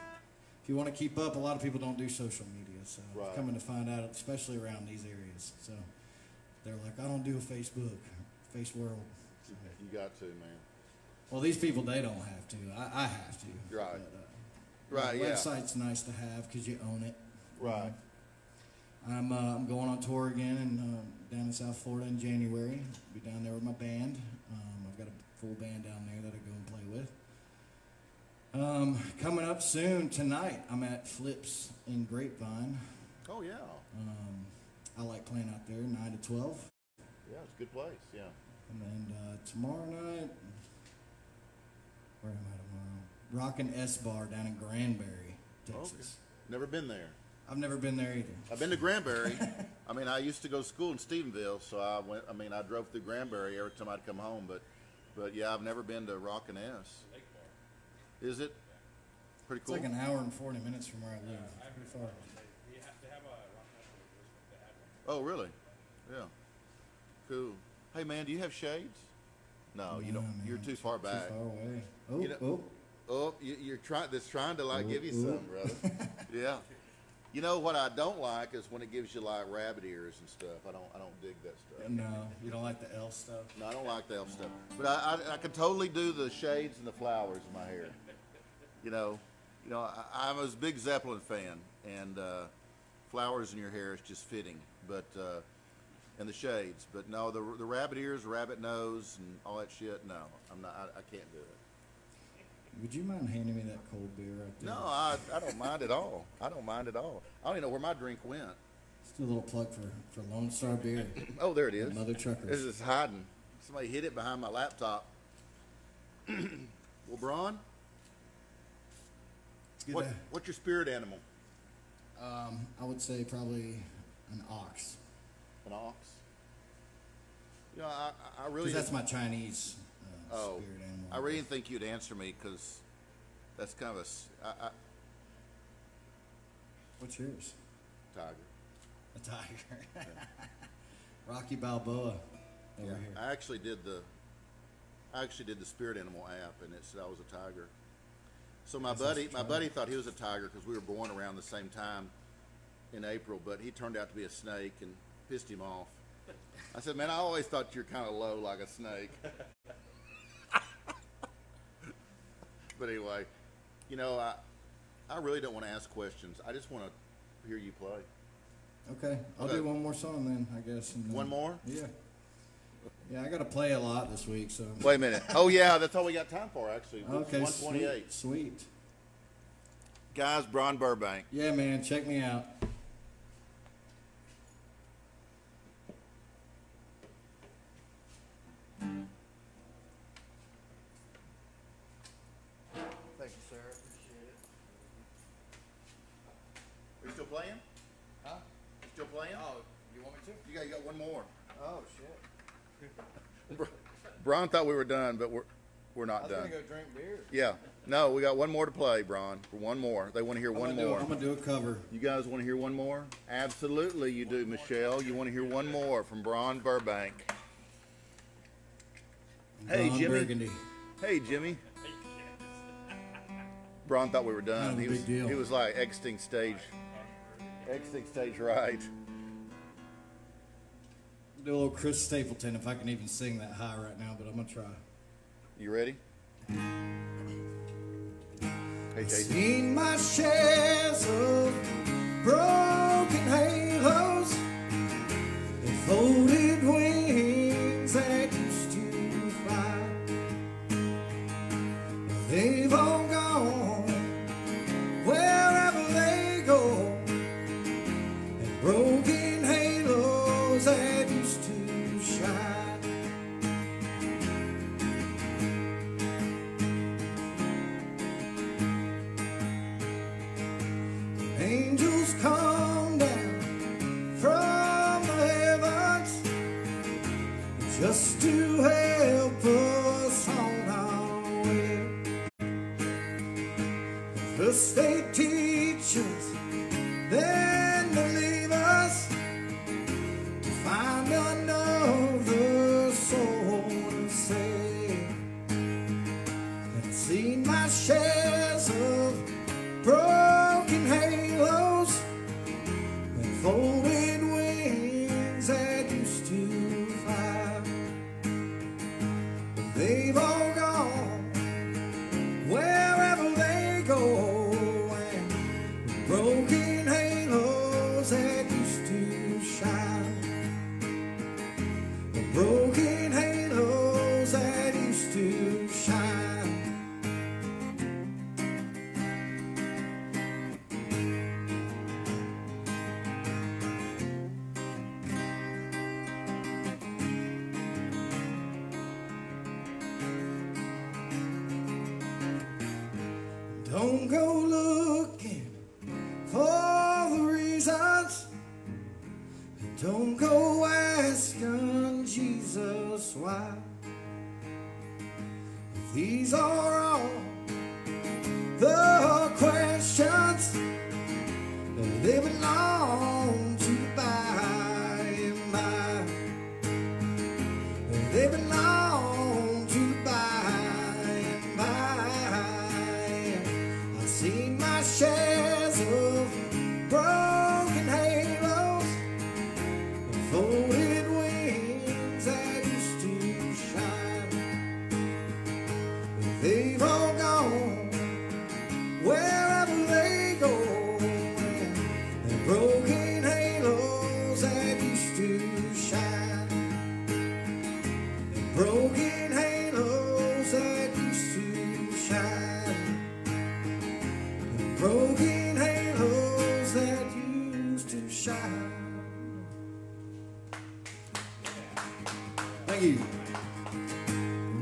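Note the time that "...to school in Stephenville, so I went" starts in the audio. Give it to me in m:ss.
0:50.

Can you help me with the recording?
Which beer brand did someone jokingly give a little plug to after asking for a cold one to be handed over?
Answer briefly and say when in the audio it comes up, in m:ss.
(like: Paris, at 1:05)
Lone Star, at 1:50.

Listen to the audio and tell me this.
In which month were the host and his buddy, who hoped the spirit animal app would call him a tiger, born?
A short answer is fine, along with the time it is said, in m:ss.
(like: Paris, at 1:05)
April, at 2:33.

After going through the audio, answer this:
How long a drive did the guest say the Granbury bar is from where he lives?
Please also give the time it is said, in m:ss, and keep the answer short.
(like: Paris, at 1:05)
1 hour 40 minutes, at 0:59.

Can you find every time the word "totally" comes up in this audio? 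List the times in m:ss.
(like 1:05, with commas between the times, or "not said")
1:25.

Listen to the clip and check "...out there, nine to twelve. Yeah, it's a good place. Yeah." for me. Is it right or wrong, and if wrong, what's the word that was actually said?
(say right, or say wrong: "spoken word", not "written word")
right.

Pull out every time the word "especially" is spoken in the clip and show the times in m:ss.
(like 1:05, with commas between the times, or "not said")
0:04.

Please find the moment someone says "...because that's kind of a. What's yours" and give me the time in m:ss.
2:12.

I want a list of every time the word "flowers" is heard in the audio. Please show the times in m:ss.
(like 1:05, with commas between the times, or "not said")
1:26, 1:33.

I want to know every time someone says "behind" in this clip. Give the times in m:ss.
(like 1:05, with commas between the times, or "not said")
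1:54.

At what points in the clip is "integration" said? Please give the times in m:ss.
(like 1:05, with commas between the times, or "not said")
not said.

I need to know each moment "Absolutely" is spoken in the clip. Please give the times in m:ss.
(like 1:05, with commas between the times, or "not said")
3:33.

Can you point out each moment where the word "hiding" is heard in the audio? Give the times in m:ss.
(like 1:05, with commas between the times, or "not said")
1:52.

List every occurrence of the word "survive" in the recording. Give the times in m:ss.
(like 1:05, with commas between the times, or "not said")
not said.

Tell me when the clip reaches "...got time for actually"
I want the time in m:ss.
2:56.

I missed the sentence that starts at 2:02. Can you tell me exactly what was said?
Um, I would say probably an ox.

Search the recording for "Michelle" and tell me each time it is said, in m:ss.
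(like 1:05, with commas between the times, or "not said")
3:34.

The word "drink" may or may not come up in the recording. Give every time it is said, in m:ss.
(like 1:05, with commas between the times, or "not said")
1:47, 3:26.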